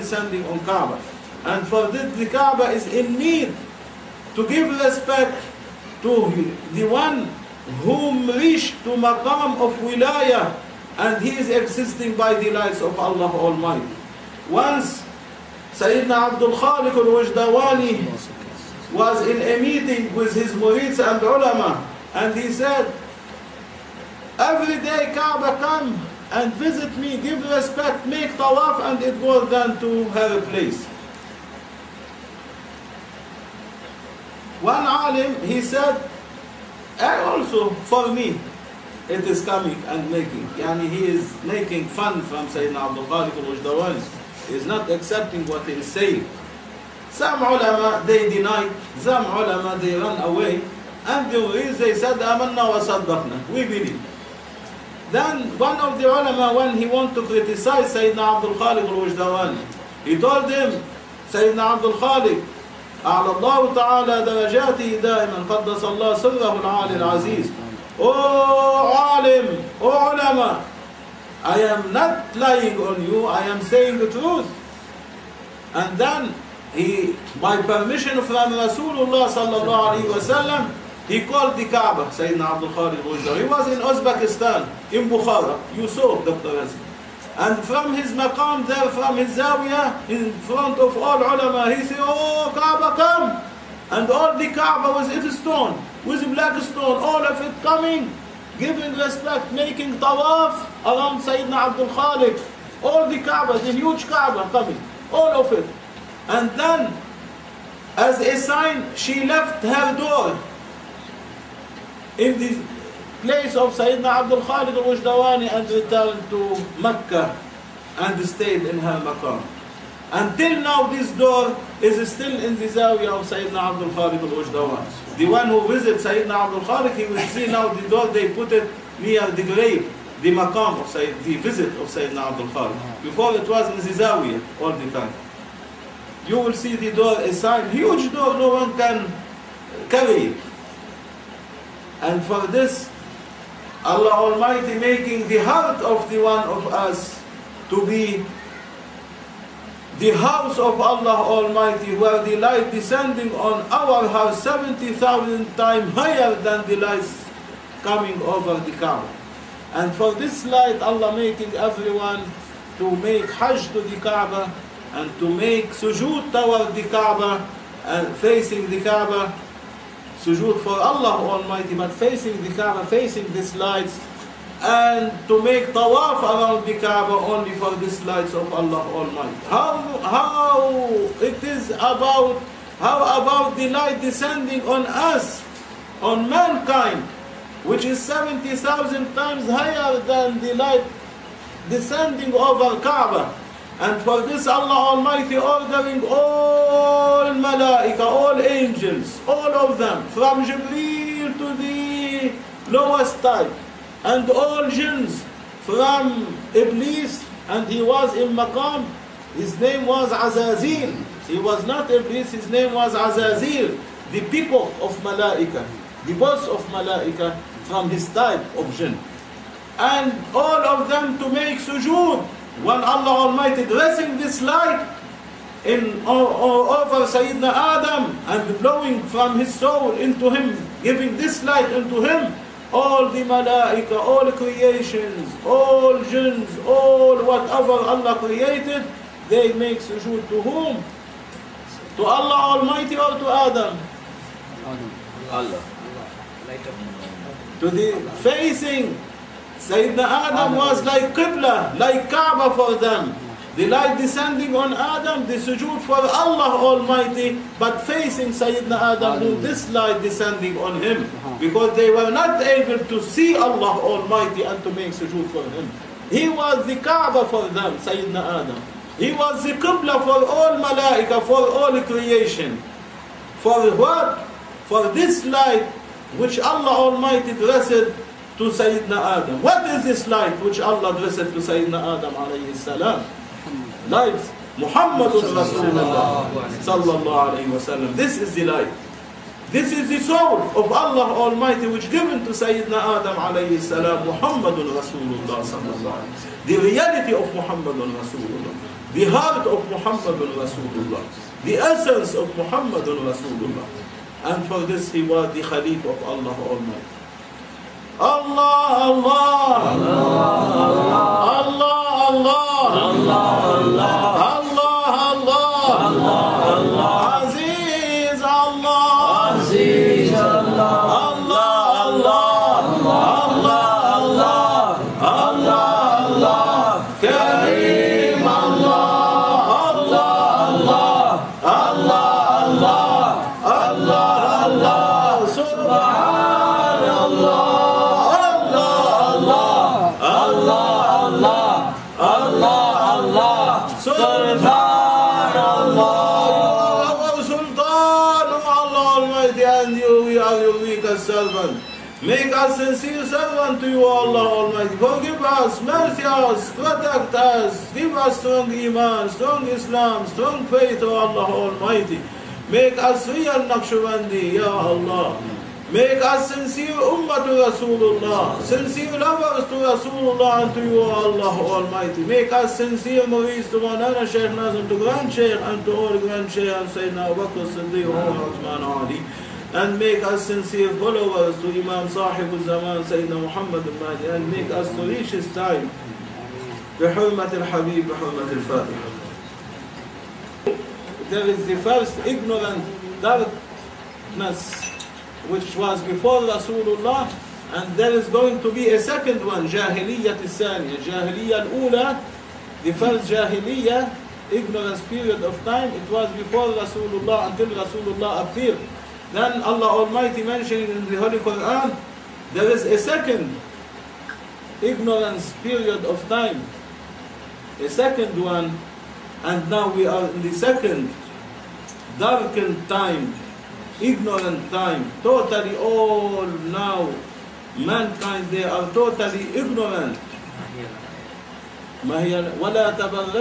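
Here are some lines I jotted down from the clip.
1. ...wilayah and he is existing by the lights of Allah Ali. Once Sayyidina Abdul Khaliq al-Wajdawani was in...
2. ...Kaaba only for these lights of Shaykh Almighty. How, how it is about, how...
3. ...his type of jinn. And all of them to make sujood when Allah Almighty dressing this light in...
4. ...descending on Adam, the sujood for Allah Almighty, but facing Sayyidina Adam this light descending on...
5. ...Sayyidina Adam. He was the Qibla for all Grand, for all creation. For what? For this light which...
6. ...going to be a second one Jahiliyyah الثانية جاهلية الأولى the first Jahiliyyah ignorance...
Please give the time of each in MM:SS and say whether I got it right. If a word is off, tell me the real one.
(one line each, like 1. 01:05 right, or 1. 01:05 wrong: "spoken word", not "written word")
1. 00:09 wrong: "Almighty", not "Ali"
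2. 02:56 wrong: "Allah", not "Shaykh"
3. 03:37 right
4. 04:14 right
5. 04:27 wrong: "Malaika", not "Grand"
6. 06:38 right.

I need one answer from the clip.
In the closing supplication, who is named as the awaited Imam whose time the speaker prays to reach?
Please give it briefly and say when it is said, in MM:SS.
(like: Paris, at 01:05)
Sayyidina Muhammad al-Mahdi, at 06:22.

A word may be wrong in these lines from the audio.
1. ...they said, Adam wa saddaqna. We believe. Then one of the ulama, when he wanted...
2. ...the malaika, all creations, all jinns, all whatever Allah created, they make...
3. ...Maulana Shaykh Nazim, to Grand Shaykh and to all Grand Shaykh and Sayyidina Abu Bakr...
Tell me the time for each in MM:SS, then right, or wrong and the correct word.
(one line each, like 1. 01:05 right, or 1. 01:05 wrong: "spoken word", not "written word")
1. 00:51 wrong: "Amanna", not "Adam"
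2. 03:53 right
3. 06:13 right.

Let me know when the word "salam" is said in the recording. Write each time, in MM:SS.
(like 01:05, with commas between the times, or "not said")
04:42, 04:53.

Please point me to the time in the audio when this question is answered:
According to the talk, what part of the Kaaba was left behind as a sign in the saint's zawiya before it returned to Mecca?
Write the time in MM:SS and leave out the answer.
01:49.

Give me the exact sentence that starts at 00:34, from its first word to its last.
One alim, he said, and eh, also for me, it is coming and making.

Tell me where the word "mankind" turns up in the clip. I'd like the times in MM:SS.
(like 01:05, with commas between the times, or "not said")
03:06, 07:07.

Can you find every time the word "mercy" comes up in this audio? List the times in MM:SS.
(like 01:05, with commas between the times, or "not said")
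05:55.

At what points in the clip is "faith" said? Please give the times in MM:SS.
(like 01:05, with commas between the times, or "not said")
06:00.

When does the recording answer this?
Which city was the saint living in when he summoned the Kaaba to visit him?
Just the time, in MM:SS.
01:25.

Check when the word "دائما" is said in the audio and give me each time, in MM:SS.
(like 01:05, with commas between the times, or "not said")
01:05.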